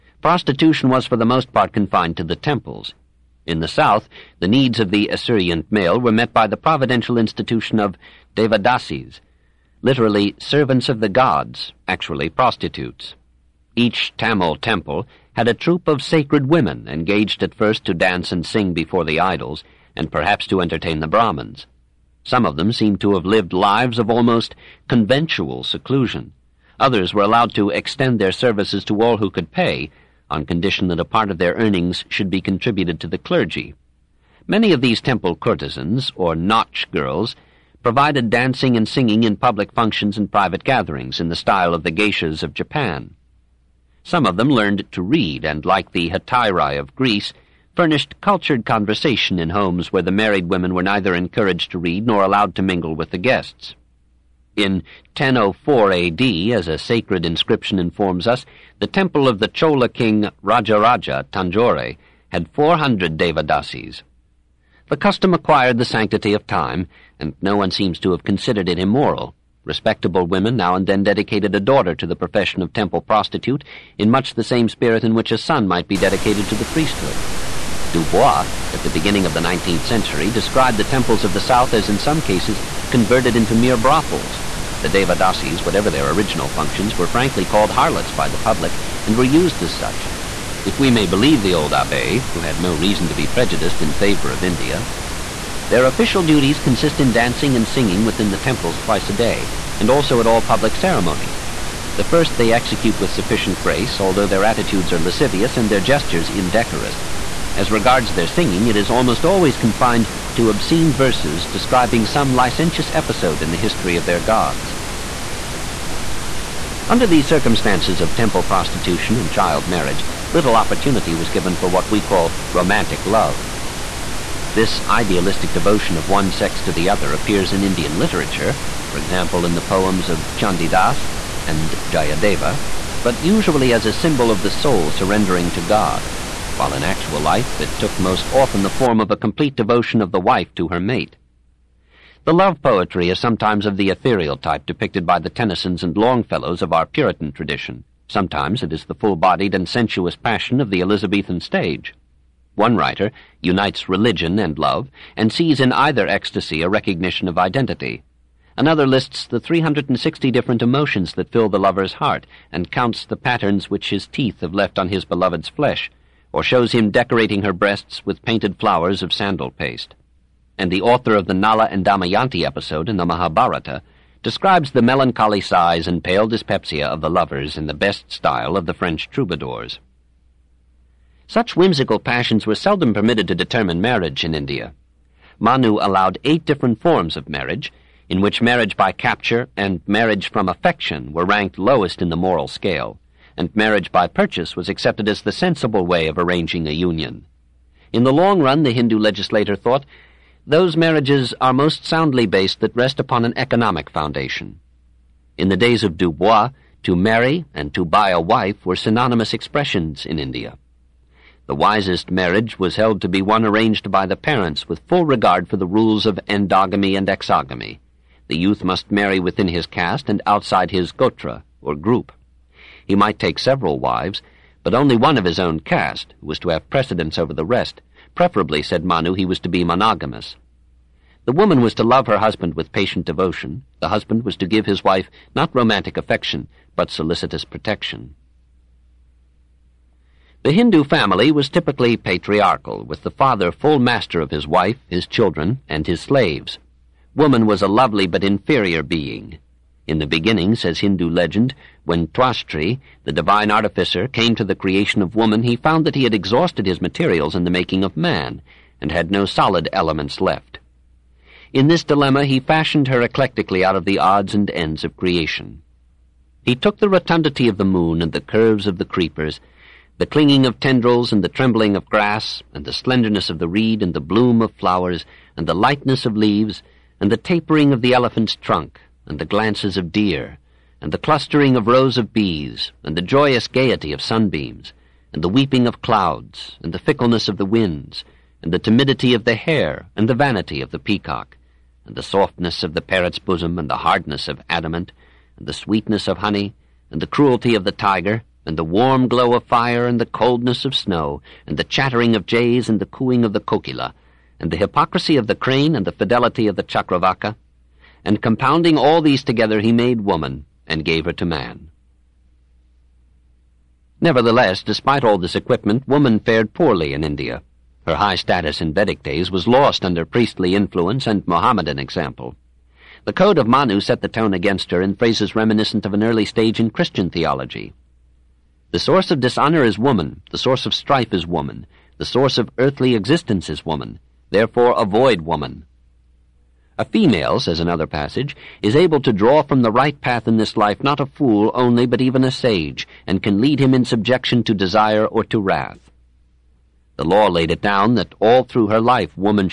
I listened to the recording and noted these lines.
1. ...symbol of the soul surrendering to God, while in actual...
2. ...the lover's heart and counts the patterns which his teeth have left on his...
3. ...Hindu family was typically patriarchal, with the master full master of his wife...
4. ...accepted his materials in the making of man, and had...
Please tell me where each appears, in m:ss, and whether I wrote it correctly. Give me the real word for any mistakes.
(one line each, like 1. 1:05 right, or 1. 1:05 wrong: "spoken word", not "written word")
1. 2:13 right
2. 2:41 right
3. 4:00 wrong: "father", not "master"
4. 4:16 wrong: "exhausted", not "accepted".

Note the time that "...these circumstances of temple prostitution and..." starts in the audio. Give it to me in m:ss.
1:57.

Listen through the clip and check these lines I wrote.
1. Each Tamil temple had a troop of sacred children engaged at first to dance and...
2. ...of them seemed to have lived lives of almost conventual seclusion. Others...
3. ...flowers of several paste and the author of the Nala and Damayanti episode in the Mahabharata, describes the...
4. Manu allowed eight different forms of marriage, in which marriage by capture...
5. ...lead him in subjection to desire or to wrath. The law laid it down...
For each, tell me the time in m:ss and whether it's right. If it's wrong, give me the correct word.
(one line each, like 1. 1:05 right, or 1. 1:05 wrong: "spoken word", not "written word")
1. 0:13 wrong: "women", not "children"
2. 0:22 right
3. 2:48 wrong: "sandal", not "several"
4. 3:05 right
5. 5:43 right.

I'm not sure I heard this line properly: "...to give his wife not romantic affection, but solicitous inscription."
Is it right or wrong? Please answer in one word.
wrong.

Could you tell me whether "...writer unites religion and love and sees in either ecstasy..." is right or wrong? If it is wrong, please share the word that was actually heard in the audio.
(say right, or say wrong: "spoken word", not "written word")
right.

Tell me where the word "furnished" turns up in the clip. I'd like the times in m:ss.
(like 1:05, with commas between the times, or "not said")
0:47.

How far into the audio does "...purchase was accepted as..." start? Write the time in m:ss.
3:14.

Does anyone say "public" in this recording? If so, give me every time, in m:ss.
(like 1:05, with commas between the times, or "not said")
0:39, 1:28, 1:40.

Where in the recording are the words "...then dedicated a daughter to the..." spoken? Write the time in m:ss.
1:10.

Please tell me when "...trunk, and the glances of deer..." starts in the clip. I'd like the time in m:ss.
4:38.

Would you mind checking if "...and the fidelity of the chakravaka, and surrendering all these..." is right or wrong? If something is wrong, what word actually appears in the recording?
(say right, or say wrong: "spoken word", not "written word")
wrong: "compounding", not "surrendering".